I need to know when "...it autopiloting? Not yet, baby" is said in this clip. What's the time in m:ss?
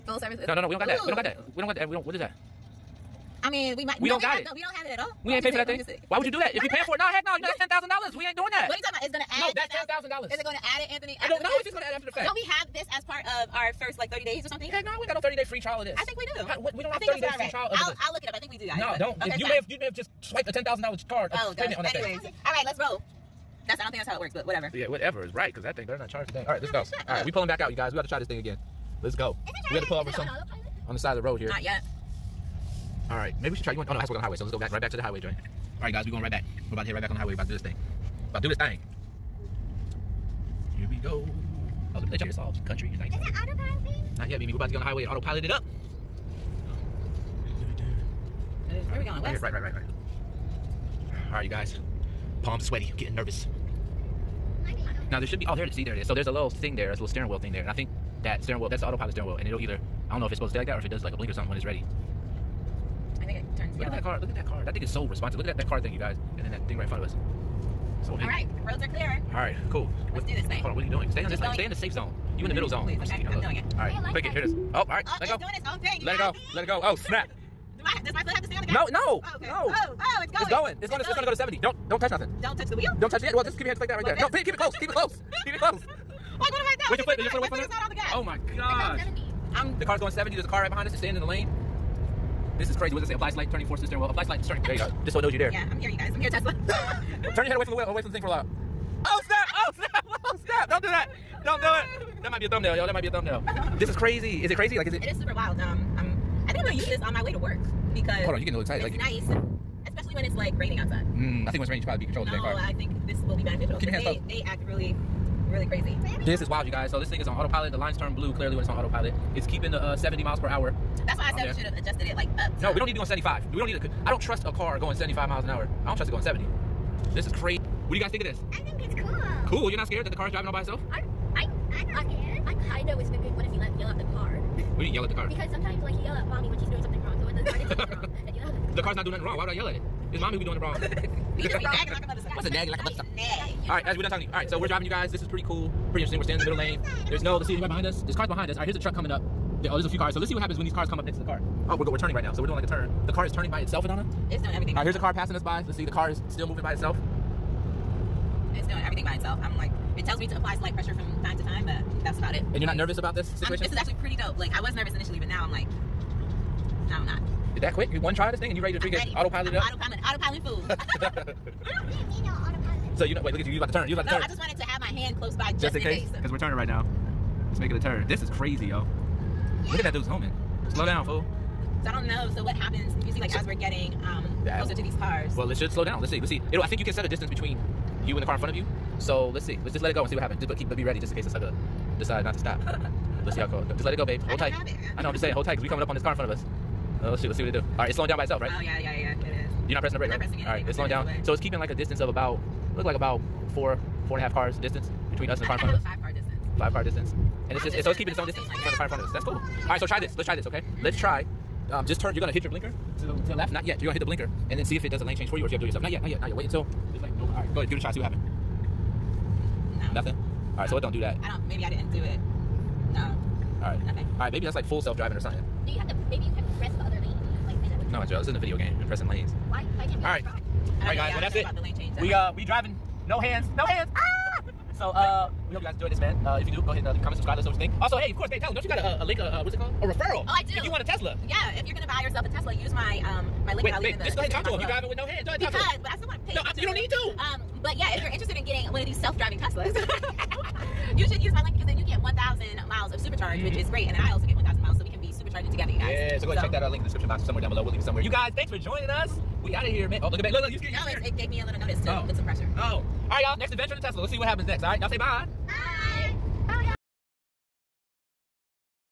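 0:43.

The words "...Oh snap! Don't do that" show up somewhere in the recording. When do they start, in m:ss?
1:40.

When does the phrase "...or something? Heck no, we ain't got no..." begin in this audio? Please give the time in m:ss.
0:14.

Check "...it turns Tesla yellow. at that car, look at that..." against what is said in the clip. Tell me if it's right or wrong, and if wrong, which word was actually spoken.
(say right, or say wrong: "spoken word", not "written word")
wrong: "Look", not "Tesla".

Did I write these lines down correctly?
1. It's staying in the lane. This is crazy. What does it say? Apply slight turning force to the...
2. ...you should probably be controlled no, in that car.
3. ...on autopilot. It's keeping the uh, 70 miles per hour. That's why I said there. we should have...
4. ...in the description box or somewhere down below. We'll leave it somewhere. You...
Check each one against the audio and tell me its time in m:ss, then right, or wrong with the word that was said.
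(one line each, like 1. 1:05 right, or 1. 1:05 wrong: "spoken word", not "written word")
1. 1:30 right
2. 1:51 right
3. 1:58 right
4. 4:16 right.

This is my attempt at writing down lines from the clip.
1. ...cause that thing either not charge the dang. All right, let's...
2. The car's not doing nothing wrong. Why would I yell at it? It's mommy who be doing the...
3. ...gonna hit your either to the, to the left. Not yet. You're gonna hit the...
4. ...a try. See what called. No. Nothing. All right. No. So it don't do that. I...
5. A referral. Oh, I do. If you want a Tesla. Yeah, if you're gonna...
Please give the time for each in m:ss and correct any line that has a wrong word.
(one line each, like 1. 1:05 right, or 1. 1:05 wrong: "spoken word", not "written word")
1. 0:25 wrong: "better", not "either"
2. 2:18 right
3. 3:32 wrong: "blinker", not "either"
4. 3:37 wrong: "happened", not "called"
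5. 3:59 right.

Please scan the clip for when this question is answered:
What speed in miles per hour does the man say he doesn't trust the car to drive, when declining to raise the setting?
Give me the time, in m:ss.
2:04.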